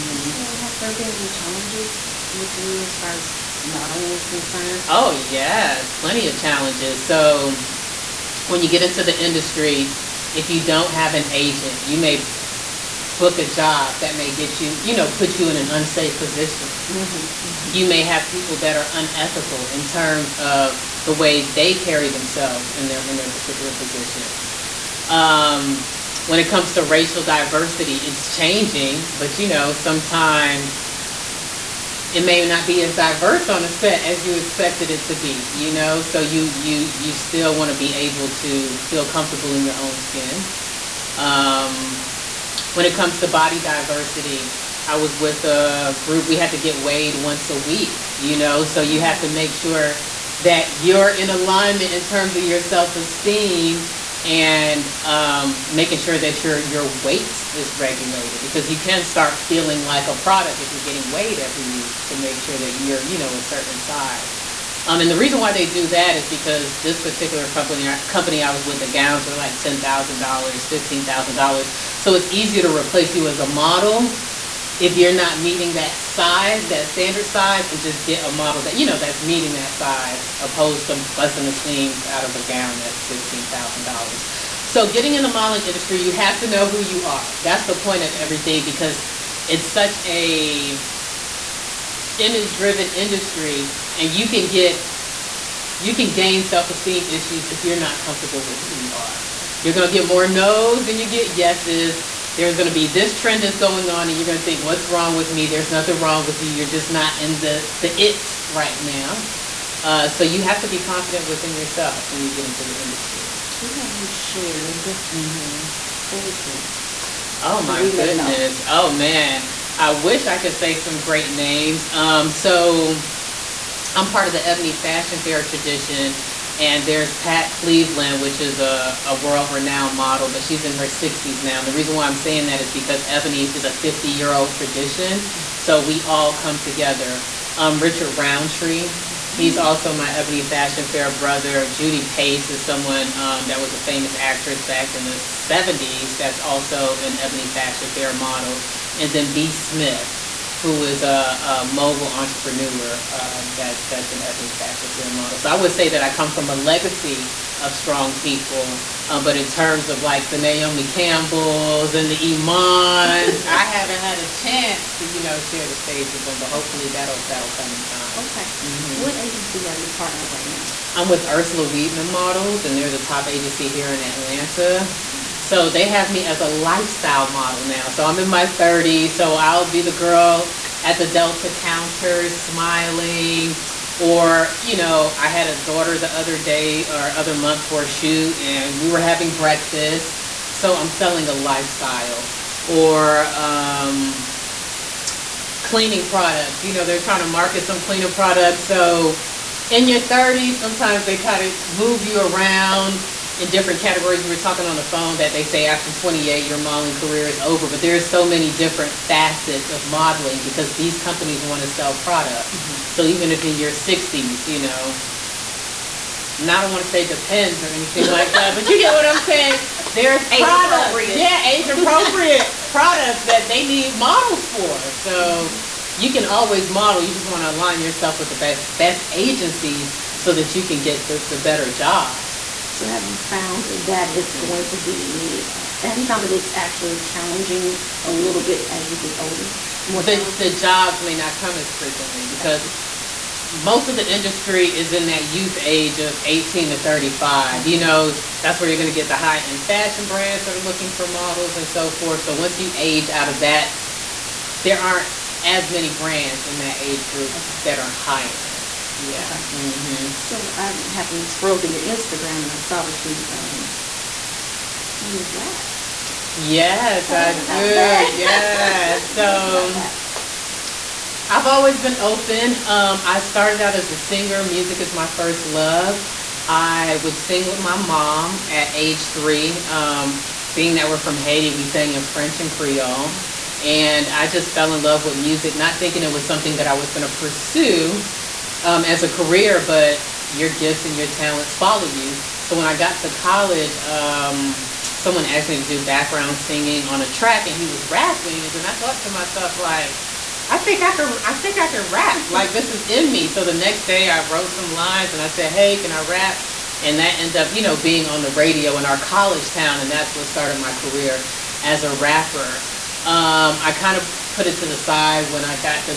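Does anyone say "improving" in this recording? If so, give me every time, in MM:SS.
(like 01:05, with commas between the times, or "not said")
not said.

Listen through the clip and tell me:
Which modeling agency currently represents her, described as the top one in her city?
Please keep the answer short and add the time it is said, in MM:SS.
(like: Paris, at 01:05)
Ursula Weidman Models, at 02:51.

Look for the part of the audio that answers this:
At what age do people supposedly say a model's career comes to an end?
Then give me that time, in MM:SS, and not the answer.
03:25.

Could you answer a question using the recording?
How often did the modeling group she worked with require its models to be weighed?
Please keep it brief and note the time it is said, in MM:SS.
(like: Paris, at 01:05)
once a week, at 00:47.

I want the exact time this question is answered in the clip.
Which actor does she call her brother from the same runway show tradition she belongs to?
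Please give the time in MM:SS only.
02:17.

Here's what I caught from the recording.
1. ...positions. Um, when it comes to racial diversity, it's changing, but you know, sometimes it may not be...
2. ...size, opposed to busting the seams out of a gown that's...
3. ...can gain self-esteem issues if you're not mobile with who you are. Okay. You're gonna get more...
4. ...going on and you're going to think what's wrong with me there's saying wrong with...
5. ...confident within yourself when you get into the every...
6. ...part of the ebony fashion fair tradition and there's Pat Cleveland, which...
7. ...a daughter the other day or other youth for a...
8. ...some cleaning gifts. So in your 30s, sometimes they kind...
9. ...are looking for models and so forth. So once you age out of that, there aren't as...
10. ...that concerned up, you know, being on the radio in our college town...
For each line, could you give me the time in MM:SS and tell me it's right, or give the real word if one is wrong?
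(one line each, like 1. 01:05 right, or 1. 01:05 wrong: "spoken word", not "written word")
1. 00:23 right
2. 01:19 right
3. 01:35 wrong: "comfortable", not "mobile"
4. 01:43 wrong: "nothing", not "saying"
5. 01:50 wrong: "industry", not "every"
6. 02:04 right
7. 03:05 wrong: "month", not "youth"
8. 03:17 wrong: "products", not "gifts"
9. 04:10 right
10. 05:06 wrong: "ended", not "concerned".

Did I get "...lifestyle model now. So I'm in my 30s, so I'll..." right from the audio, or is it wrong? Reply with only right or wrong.
right.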